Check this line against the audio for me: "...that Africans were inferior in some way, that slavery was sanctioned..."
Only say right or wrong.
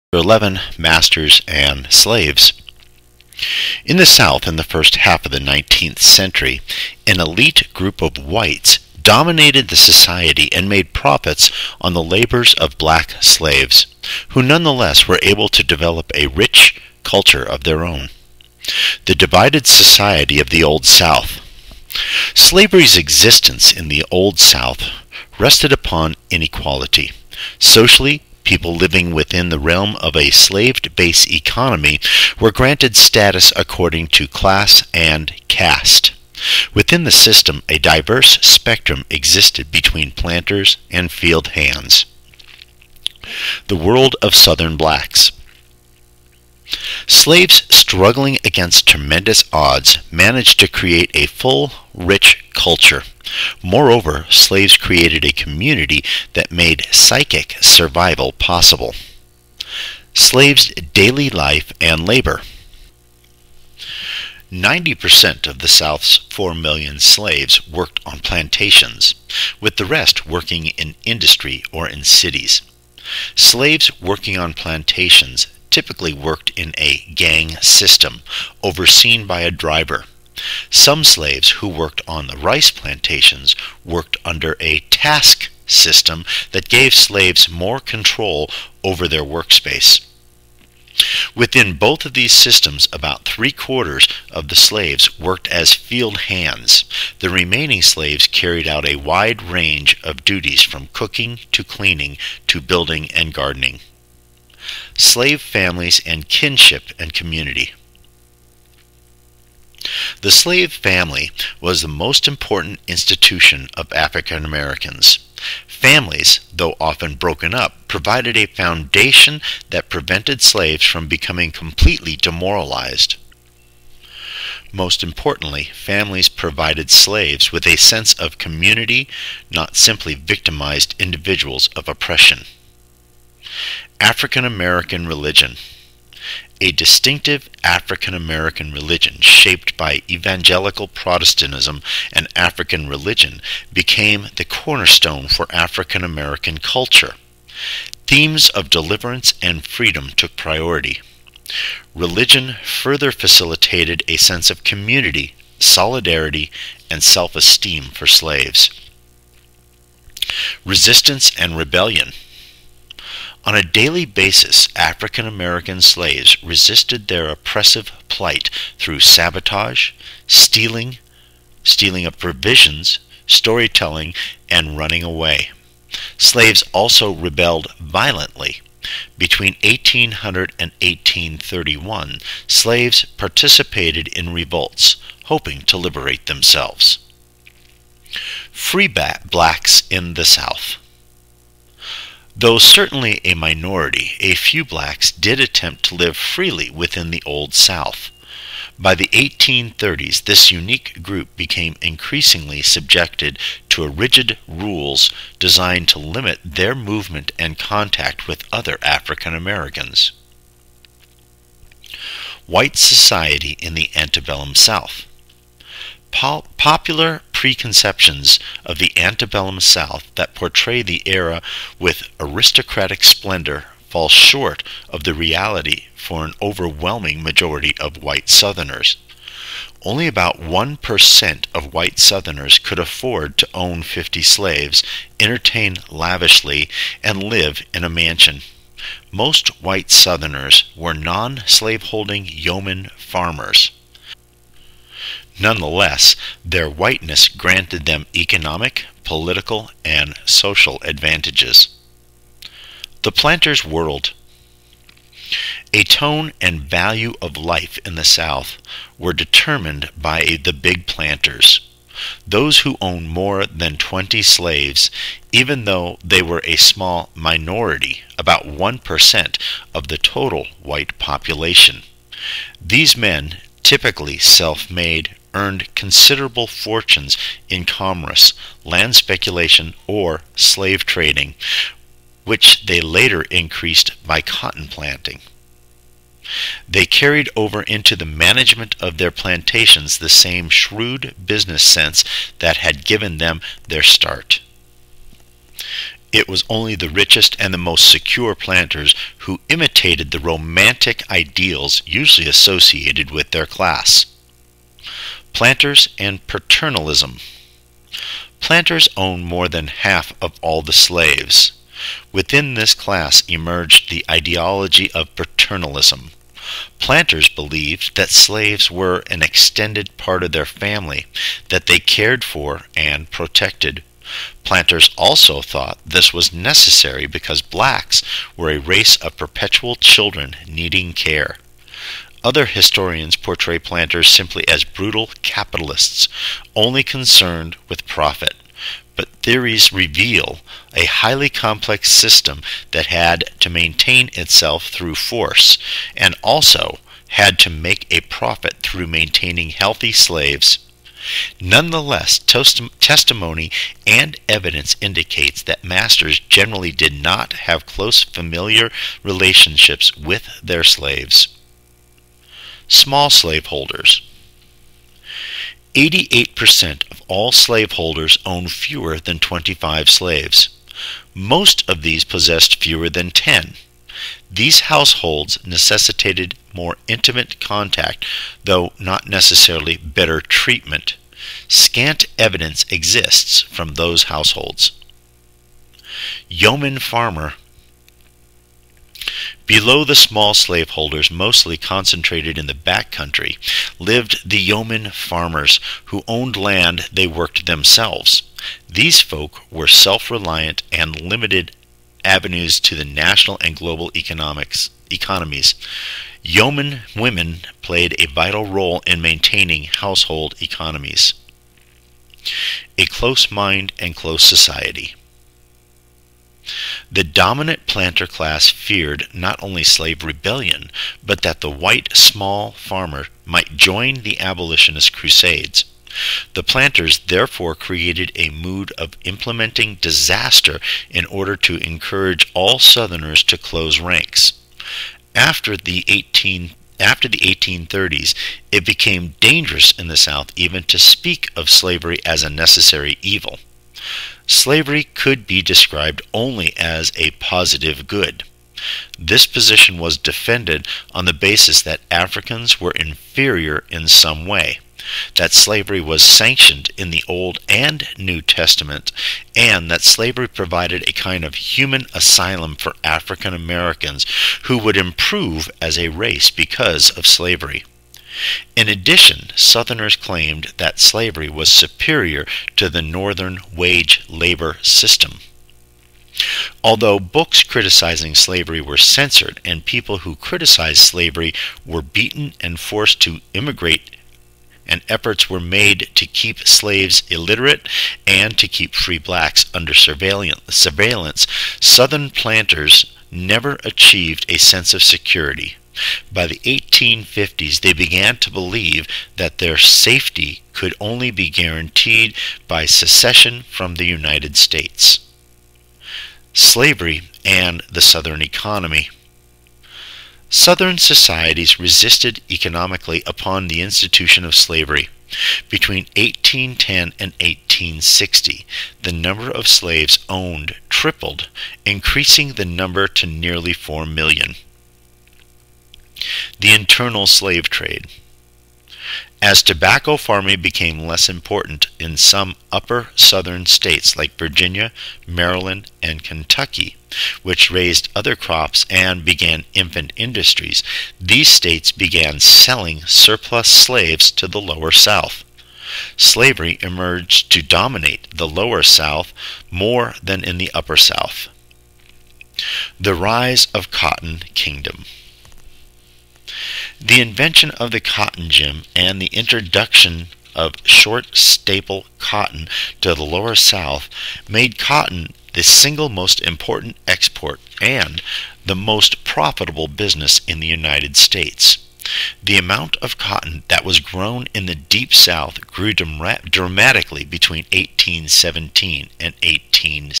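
right.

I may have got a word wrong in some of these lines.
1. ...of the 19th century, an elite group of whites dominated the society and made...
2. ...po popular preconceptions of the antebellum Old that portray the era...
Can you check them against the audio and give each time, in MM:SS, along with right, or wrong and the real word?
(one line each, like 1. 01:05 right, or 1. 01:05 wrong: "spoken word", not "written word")
1. 00:05 right
2. 03:36 wrong: "South", not "Old".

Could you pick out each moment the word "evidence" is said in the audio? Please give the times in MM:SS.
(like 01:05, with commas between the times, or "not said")
05:54, 06:22.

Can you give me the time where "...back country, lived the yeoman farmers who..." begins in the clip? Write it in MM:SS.
06:32.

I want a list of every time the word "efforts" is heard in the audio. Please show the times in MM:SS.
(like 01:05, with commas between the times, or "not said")
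08:04.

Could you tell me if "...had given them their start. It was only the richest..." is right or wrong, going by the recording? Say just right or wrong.
right.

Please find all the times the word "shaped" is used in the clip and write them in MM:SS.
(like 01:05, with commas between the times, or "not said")
02:19.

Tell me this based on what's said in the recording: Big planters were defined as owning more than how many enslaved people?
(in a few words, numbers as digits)
20.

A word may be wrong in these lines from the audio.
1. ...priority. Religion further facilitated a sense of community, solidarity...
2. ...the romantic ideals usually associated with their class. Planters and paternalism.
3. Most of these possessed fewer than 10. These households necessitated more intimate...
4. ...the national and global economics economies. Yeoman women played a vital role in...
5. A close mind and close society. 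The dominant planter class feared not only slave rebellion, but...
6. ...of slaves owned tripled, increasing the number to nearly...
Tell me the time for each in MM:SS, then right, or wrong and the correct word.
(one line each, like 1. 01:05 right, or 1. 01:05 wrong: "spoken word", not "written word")
1. 02:30 right
2. 05:00 right
3. 06:11 right
4. 06:42 right
5. 06:52 right
6. 08:39 right.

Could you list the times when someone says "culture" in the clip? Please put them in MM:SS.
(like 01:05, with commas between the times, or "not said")
00:17, 00:52, 02:26.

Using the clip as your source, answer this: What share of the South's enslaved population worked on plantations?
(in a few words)
90%.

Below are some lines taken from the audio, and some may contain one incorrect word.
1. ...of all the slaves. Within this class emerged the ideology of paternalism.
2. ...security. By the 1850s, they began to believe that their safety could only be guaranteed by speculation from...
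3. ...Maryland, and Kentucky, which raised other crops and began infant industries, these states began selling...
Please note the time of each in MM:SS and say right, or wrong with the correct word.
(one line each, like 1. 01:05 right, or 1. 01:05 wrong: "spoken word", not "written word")
1. 05:10 right
2. 08:14 wrong: "secession", not "speculation"
3. 08:55 right.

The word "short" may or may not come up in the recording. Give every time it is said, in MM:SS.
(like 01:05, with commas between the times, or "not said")
03:44, 09:20.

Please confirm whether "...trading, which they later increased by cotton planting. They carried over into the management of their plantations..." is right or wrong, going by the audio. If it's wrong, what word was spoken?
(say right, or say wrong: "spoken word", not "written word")
right.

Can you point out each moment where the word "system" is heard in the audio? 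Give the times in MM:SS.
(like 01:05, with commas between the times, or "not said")
00:37, 01:17, 01:25, 01:32, 05:41, 07:54.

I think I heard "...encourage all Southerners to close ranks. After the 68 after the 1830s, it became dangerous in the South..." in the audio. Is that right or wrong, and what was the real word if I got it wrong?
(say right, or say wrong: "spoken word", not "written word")
wrong: "18", not "68".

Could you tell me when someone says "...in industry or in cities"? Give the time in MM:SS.
01:10.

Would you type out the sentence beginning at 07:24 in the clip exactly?
Slavery could be described only as a positive good.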